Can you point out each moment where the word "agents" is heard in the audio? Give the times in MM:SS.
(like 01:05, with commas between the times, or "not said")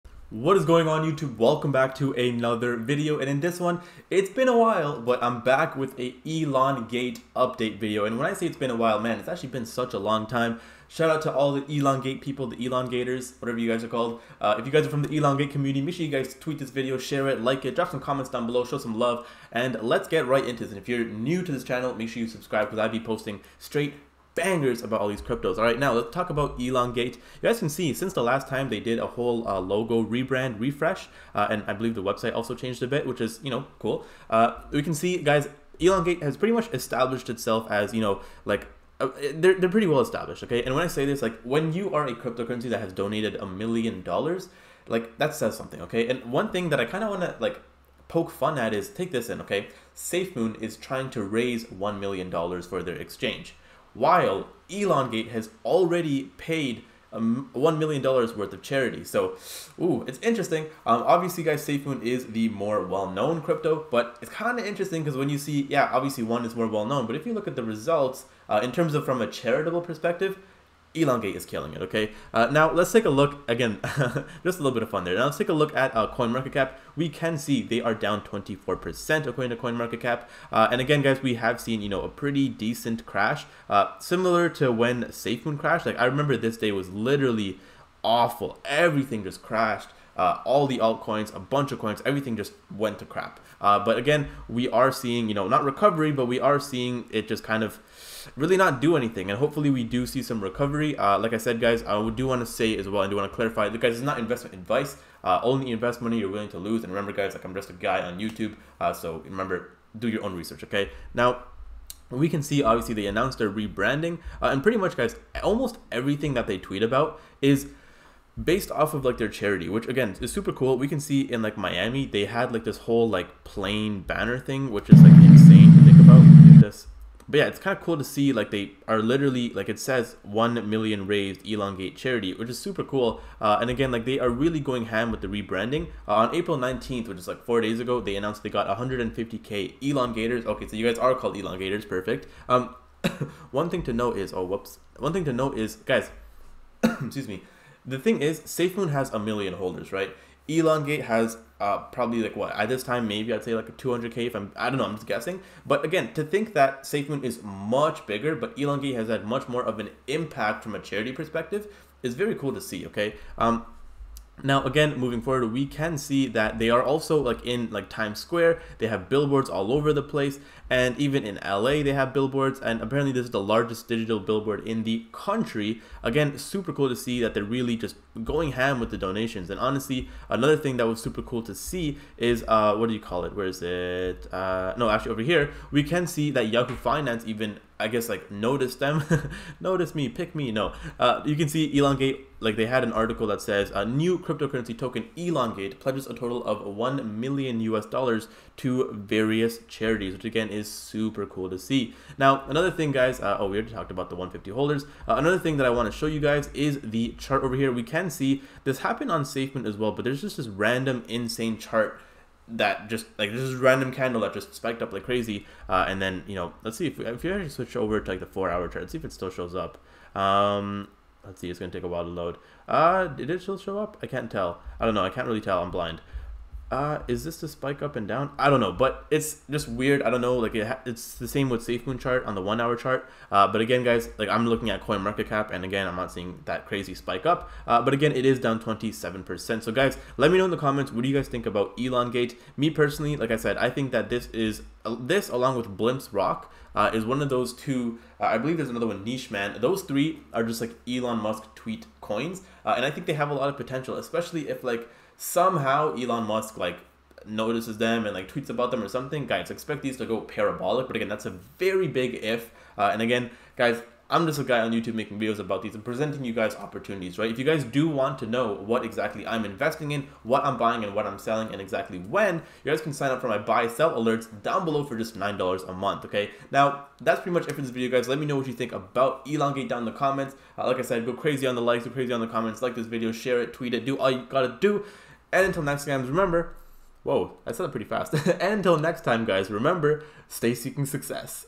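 not said.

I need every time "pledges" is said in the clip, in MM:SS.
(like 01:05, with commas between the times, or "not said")
03:15.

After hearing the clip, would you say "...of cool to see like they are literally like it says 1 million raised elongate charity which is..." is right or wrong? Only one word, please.
right.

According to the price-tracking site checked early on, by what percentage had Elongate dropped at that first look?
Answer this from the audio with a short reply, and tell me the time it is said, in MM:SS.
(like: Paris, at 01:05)
24%, at 01:18.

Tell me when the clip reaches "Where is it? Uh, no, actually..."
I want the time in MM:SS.
03:03.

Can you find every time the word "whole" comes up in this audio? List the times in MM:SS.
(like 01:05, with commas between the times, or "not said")
00:29, 02:02.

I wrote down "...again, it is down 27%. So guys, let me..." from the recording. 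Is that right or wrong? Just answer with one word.
right.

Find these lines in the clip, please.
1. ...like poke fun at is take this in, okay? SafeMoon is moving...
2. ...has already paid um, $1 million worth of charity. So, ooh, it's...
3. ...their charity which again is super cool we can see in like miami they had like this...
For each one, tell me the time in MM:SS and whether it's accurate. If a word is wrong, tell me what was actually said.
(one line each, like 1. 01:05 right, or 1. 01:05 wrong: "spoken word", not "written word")
1. 00:47 wrong: "trying", not "moving"
2. 00:55 right
3. 01:59 right.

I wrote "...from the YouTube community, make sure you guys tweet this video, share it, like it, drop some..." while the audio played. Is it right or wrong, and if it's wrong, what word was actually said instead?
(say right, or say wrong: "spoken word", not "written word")
wrong: "Elongate", not "YouTube".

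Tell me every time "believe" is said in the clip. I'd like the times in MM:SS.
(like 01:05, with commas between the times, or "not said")
00:31, 04:08.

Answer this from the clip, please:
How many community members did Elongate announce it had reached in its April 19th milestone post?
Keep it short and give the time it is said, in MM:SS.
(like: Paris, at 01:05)
150k, at 02:18.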